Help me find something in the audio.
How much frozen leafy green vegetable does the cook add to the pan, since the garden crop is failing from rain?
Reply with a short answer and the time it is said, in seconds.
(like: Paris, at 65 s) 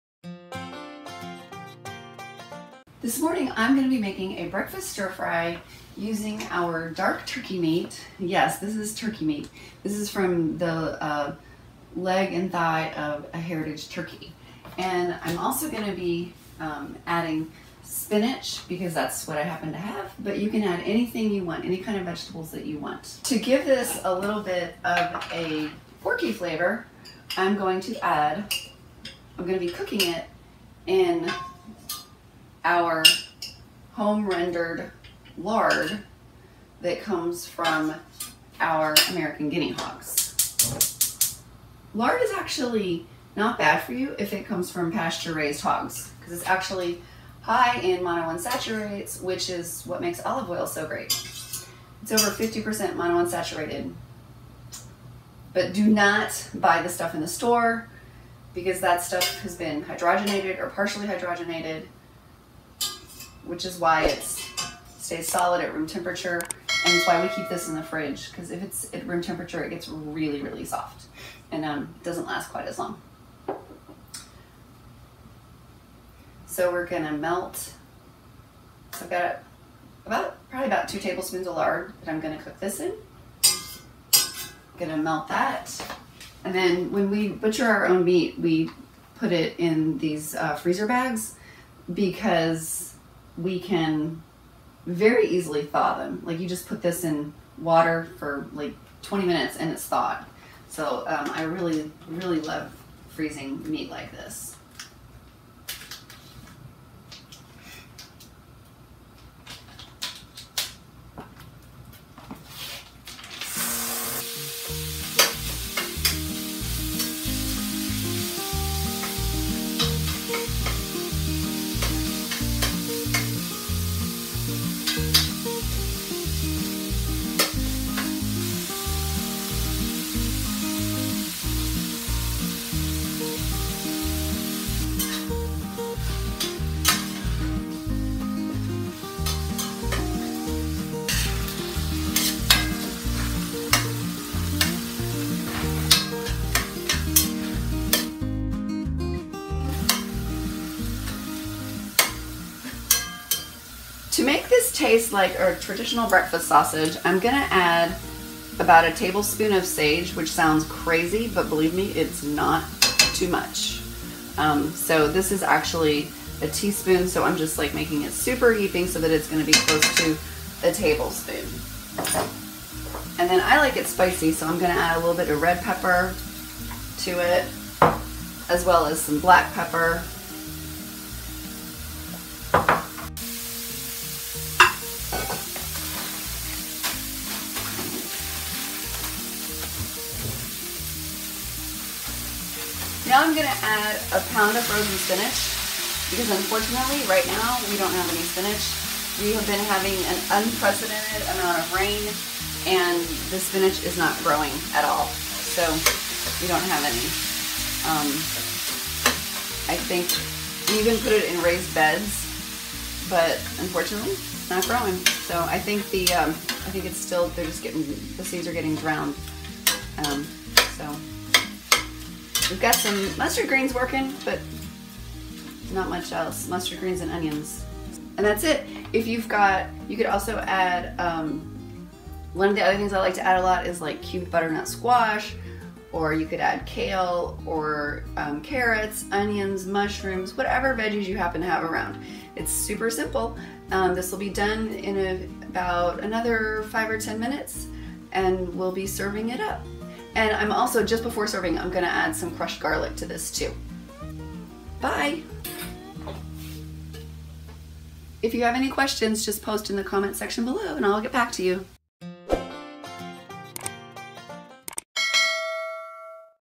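1 pound, at 194 s.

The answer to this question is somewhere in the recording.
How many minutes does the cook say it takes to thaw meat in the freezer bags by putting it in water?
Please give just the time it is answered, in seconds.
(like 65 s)
99 s.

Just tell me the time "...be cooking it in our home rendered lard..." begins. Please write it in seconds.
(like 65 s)
29 s.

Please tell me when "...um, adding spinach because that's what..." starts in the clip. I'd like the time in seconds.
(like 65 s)
16 s.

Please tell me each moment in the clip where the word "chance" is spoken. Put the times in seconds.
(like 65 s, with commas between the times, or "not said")
not said.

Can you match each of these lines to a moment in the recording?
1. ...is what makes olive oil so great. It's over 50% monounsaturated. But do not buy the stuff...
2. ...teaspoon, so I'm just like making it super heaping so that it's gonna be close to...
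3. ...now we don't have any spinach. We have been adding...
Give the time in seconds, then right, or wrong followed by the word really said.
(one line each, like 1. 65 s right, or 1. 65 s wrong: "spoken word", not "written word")
1. 49 s right
2. 166 s right
3. 197 s wrong: "having", not "adding".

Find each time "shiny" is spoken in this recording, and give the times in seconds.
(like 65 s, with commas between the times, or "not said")
not said.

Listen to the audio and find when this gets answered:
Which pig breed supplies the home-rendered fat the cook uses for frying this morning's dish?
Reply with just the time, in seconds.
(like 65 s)
39 s.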